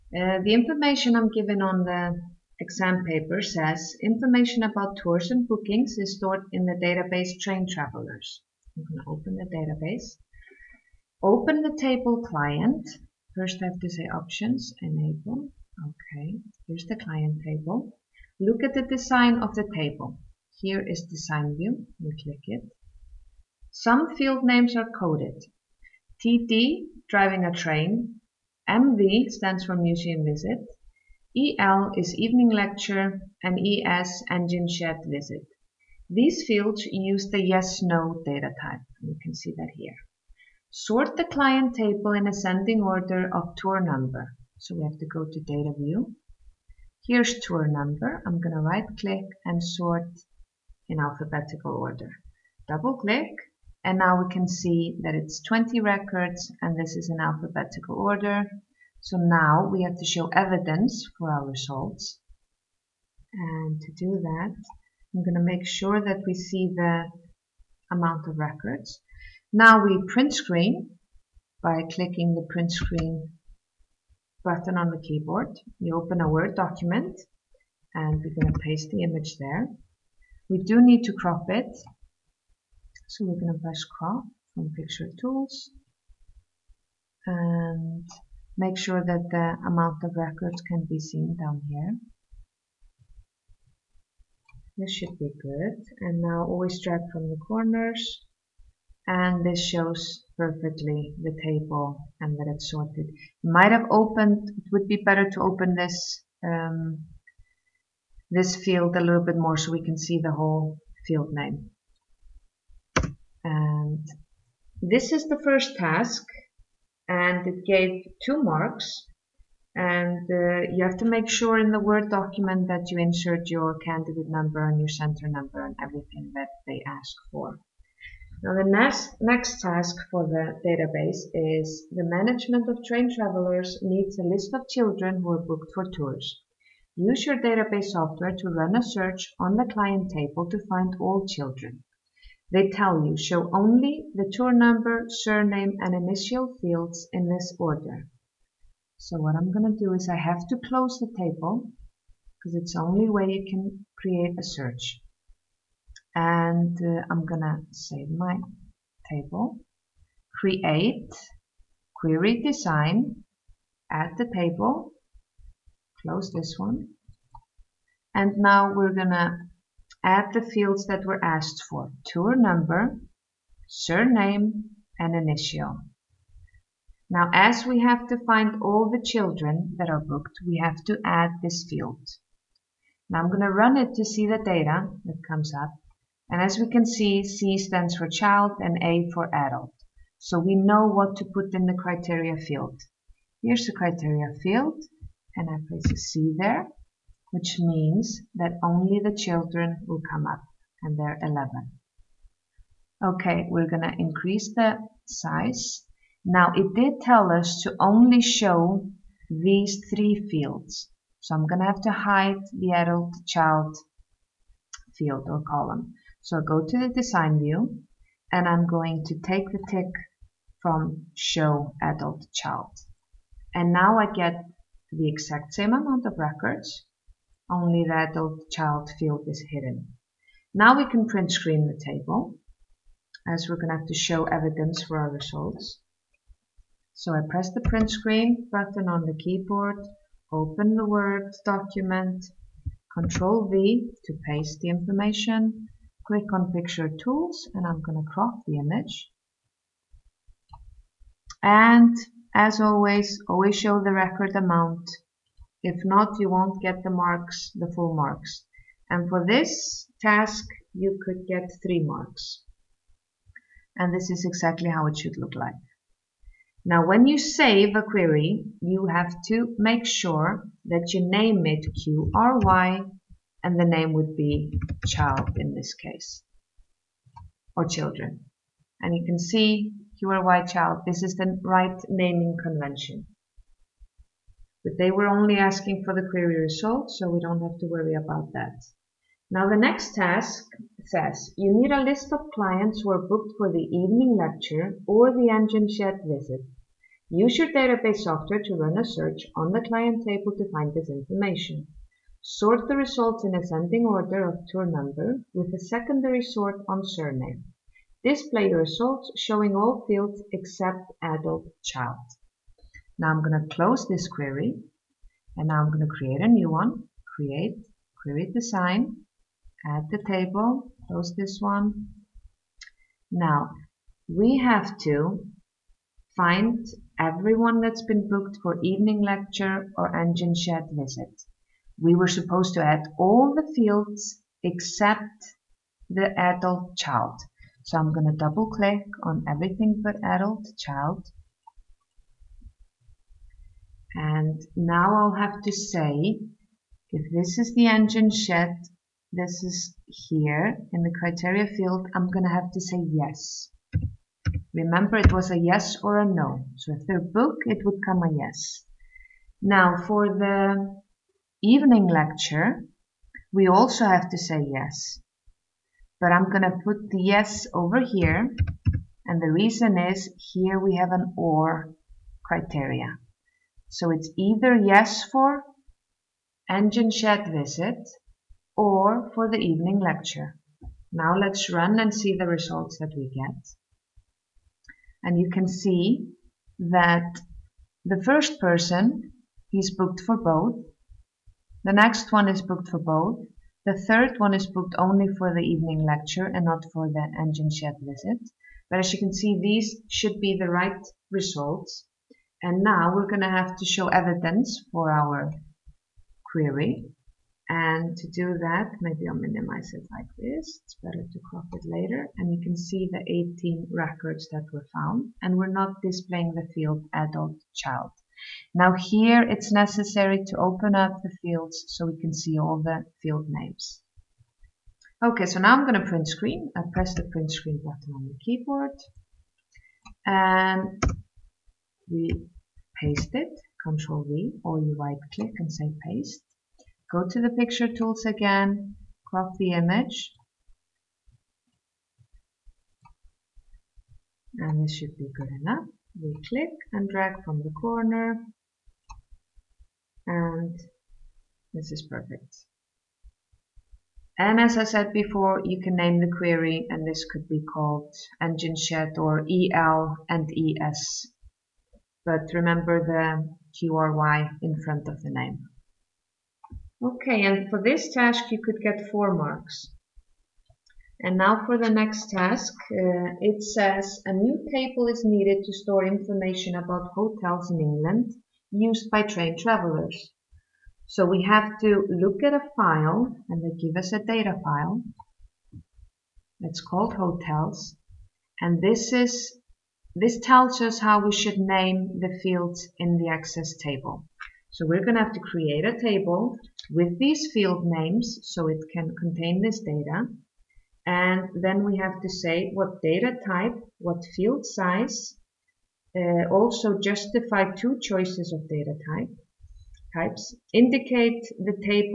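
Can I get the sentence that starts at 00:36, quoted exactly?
These fields use the yes-no data type.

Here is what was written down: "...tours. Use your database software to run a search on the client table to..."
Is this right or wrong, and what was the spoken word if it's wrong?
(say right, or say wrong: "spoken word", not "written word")
right.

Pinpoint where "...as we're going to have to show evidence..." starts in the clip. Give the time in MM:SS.
03:53.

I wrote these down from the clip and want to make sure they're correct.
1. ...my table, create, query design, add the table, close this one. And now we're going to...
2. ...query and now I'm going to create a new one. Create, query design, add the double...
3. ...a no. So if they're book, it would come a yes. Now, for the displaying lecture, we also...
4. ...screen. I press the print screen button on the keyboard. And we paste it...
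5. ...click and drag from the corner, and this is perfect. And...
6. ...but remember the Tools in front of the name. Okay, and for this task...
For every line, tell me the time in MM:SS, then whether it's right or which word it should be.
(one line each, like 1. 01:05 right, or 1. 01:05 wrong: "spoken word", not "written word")
1. 02:38 right
2. 05:14 wrong: "table", not "double"
3. 05:55 wrong: "evening", not "displaying"
4. 07:06 right
5. 07:26 right
6. 07:42 wrong: "QRY", not "Tools".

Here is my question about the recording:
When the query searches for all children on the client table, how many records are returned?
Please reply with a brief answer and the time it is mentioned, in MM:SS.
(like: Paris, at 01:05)
11, at 03:20.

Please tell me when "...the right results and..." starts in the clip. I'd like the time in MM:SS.
06:40.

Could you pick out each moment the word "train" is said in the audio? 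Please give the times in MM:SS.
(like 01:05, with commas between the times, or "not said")
00:07, 00:27, 02:12, 07:59.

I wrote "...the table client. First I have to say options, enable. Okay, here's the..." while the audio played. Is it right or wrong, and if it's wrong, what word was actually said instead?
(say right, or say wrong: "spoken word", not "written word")
right.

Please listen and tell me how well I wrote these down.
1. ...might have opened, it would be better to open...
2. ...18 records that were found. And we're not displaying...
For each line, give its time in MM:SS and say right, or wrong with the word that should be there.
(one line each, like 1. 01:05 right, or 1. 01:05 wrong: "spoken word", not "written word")
1. 01:43 right
2. 06:53 right.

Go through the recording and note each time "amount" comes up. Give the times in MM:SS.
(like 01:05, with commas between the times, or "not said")
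01:07, 01:29, 03:45, 04:14.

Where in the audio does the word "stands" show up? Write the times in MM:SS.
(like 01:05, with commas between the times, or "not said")
00:29, 03:07.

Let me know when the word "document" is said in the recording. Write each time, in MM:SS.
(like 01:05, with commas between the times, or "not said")
01:16, 02:02, 04:01.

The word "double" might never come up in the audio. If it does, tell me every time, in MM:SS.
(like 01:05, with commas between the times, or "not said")
00:52, 05:38.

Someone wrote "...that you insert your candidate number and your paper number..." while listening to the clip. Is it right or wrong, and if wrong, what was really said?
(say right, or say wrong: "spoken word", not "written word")
wrong: "center", not "paper".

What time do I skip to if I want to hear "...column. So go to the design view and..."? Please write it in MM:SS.
03:35.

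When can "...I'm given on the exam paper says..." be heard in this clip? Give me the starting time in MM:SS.
00:01.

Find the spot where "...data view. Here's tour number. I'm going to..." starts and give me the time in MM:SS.
00:45.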